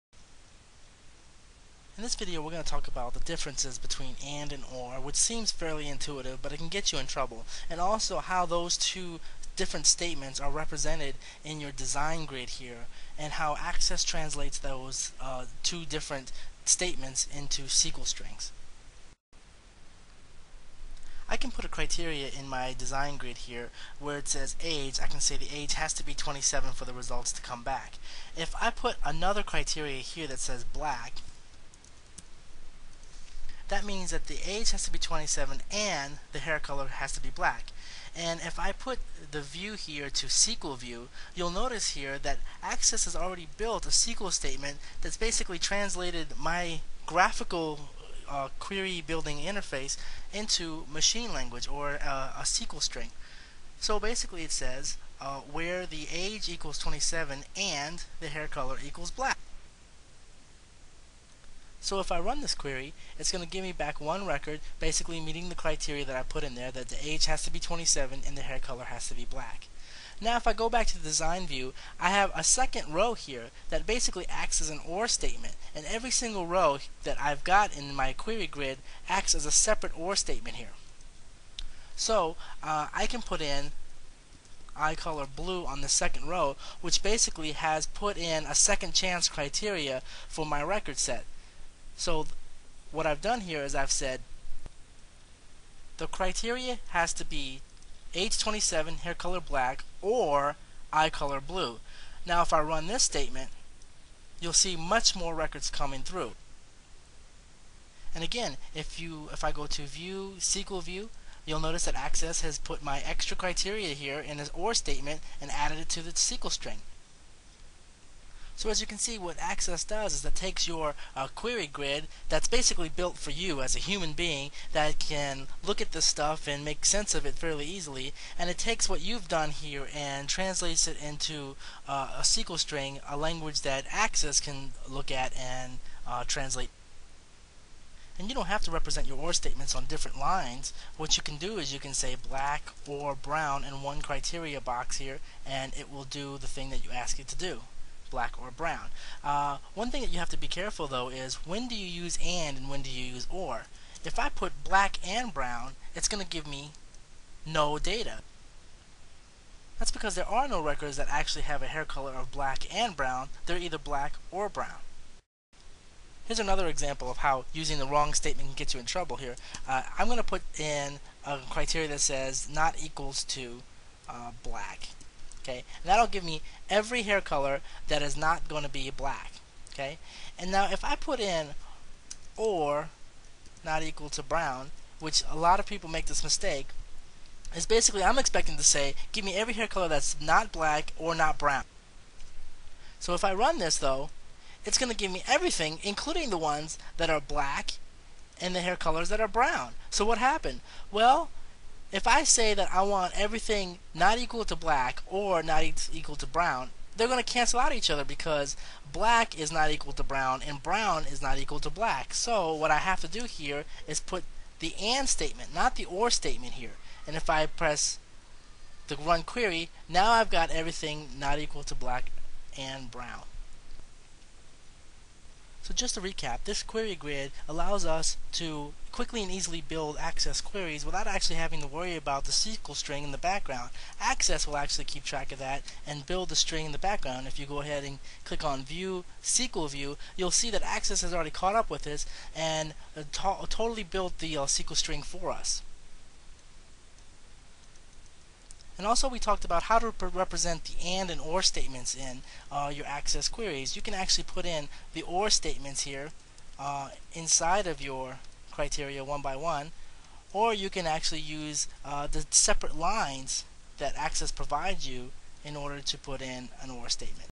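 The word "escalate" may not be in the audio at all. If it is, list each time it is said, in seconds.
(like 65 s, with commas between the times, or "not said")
not said.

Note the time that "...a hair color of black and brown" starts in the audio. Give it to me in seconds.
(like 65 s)
161 s.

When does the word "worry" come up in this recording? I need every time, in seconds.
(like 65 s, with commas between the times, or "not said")
231 s.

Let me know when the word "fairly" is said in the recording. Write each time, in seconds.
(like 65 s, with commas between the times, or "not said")
5 s, 127 s.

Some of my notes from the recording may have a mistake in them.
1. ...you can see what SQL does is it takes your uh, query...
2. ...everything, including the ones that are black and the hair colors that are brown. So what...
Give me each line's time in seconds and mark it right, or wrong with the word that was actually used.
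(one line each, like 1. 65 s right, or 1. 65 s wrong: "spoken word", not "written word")
1. 118 s wrong: "Access", not "SQL"
2. 195 s right.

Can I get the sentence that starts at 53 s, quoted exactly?
So basically it says uh, where the age equals 27 and the hair color equals black.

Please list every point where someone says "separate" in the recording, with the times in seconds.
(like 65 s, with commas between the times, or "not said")
79 s, 262 s.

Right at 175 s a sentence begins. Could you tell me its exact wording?
Okay, and that'll give me every hair color that is not going to be black.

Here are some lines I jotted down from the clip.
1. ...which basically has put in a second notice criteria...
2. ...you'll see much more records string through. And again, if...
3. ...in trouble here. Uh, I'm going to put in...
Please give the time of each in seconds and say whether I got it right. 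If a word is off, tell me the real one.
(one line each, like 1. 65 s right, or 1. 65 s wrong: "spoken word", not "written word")
1. 86 s wrong: "chance", not "notice"
2. 104 s wrong: "coming", not "string"
3. 168 s right.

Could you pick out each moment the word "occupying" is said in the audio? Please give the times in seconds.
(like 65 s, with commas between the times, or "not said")
not said.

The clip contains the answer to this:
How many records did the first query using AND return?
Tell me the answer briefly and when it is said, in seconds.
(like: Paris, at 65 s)
1, at 63 s.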